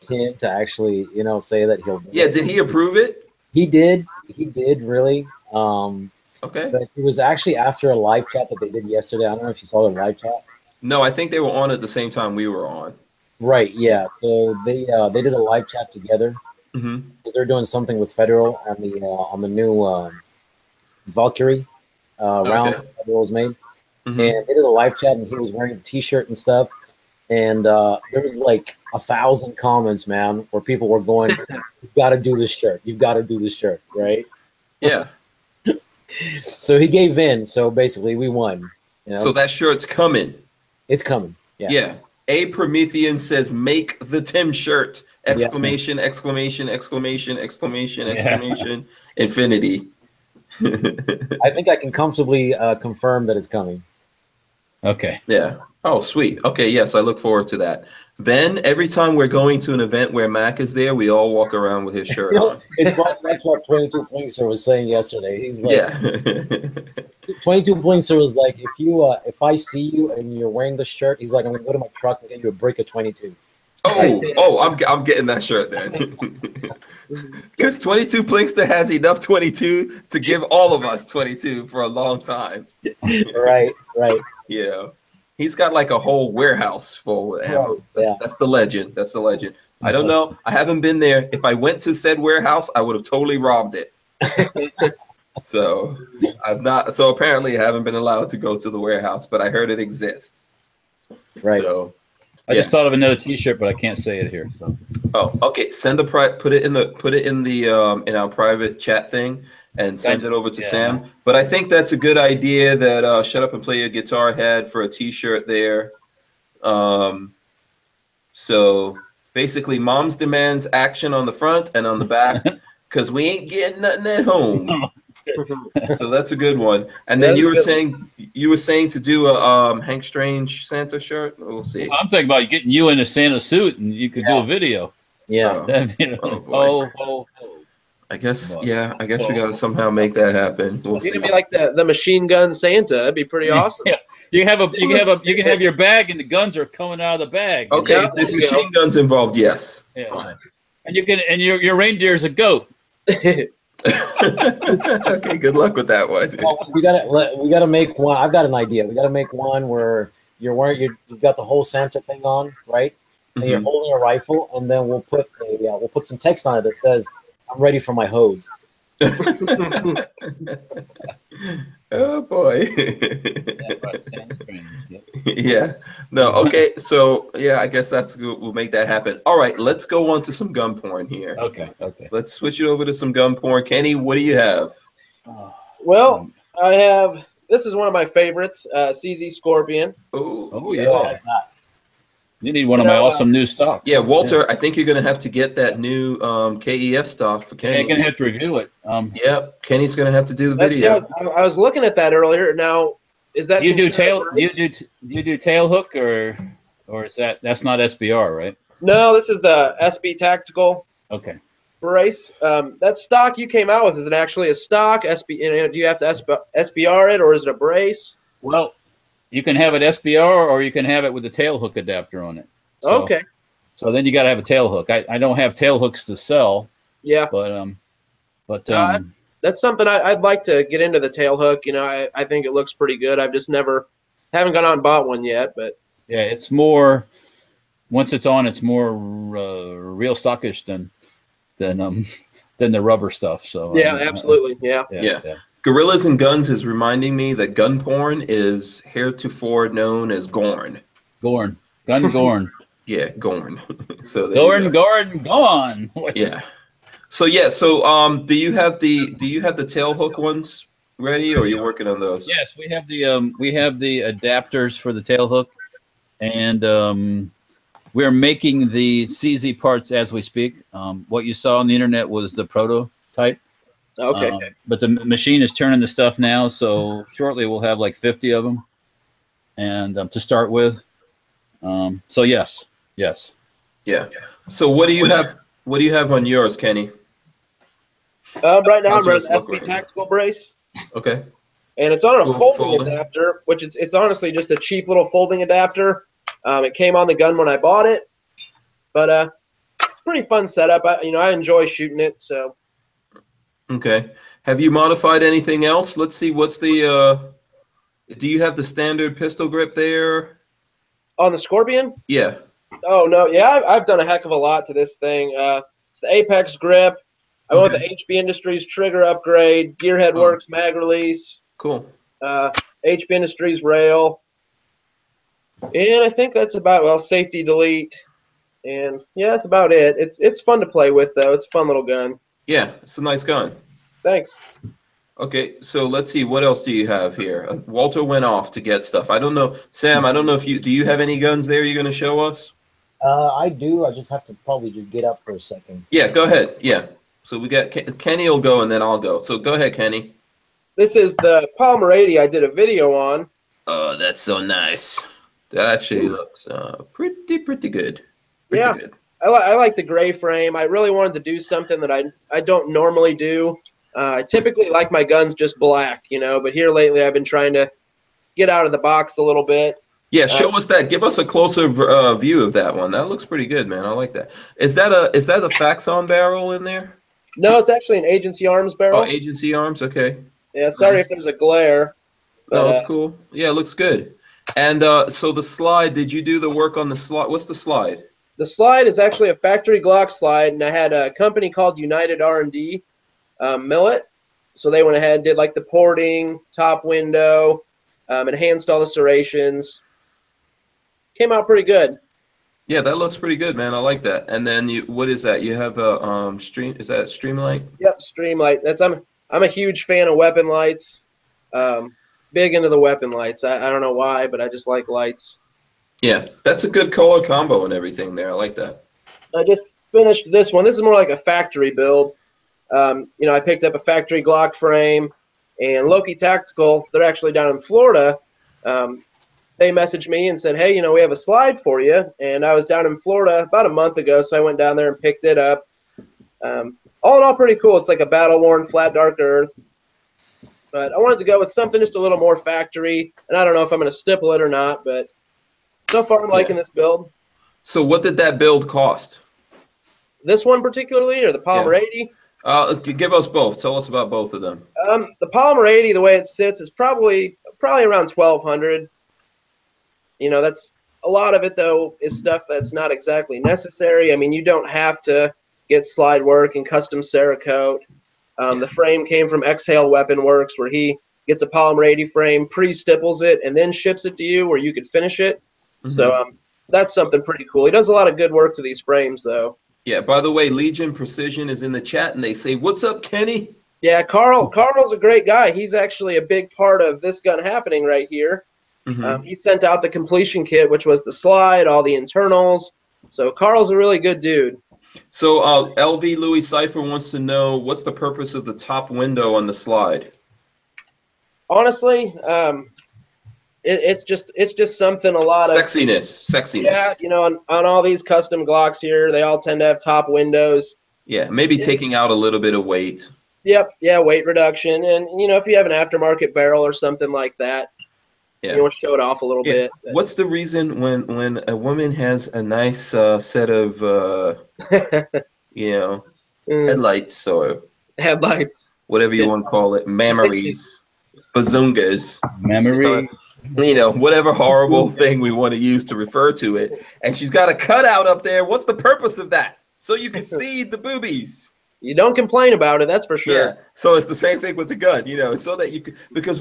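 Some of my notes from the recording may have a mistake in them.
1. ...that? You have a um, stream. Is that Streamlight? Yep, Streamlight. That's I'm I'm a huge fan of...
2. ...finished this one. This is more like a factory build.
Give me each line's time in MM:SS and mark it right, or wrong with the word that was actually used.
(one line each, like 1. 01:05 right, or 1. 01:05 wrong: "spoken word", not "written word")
1. 06:45 right
2. 06:59 right.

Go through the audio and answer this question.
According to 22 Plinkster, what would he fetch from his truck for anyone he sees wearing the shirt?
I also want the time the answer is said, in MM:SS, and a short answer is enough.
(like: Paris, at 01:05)
A brick of 22, at 01:12.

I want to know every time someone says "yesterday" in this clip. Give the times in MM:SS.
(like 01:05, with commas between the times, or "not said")
00:08, 01:04.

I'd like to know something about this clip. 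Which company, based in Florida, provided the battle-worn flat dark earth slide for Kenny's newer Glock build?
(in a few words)
Loki Tactical.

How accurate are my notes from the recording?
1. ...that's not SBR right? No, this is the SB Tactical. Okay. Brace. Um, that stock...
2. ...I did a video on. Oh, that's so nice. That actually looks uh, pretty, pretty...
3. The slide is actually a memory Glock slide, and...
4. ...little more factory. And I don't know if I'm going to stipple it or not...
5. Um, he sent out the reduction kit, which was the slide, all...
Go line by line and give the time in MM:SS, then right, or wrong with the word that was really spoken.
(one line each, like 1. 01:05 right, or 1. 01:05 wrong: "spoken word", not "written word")
1. 03:27 right
2. 05:52 right
3. 06:28 wrong: "factory", not "memory"
4. 07:21 right
5. 08:09 wrong: "completion", not "reduction".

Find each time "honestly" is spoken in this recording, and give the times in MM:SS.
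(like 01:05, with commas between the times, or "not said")
04:53, 08:21.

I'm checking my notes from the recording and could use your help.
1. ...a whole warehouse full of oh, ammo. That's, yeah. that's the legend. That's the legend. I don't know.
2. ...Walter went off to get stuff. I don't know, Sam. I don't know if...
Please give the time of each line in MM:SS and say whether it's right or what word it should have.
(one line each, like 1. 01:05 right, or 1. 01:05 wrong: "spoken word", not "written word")
1. 01:25 right
2. 05:37 right.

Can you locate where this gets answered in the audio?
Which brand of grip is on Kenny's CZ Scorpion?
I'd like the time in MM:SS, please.
05:16.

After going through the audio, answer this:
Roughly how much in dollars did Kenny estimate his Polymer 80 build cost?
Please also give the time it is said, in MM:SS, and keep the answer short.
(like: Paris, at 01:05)
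1200, at 07:38.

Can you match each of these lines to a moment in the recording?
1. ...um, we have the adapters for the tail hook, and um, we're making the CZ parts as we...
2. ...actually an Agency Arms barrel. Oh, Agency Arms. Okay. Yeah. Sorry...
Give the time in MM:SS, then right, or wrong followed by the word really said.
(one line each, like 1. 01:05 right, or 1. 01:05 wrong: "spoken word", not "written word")
1. 04:23 right
2. 06:17 right.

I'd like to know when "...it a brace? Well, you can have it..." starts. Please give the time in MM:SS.
03:37.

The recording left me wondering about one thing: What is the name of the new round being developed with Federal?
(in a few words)
Valkyrie.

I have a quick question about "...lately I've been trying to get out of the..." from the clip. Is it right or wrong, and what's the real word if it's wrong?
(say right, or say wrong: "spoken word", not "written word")
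right.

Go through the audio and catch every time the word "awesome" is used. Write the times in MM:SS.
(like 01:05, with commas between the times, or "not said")
02:23, 03:13.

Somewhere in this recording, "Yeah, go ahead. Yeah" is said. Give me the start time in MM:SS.
05:45.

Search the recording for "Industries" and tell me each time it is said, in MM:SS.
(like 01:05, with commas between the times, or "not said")
05:18, 05:23.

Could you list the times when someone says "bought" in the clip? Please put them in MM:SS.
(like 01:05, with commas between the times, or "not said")
03:54, 04:57.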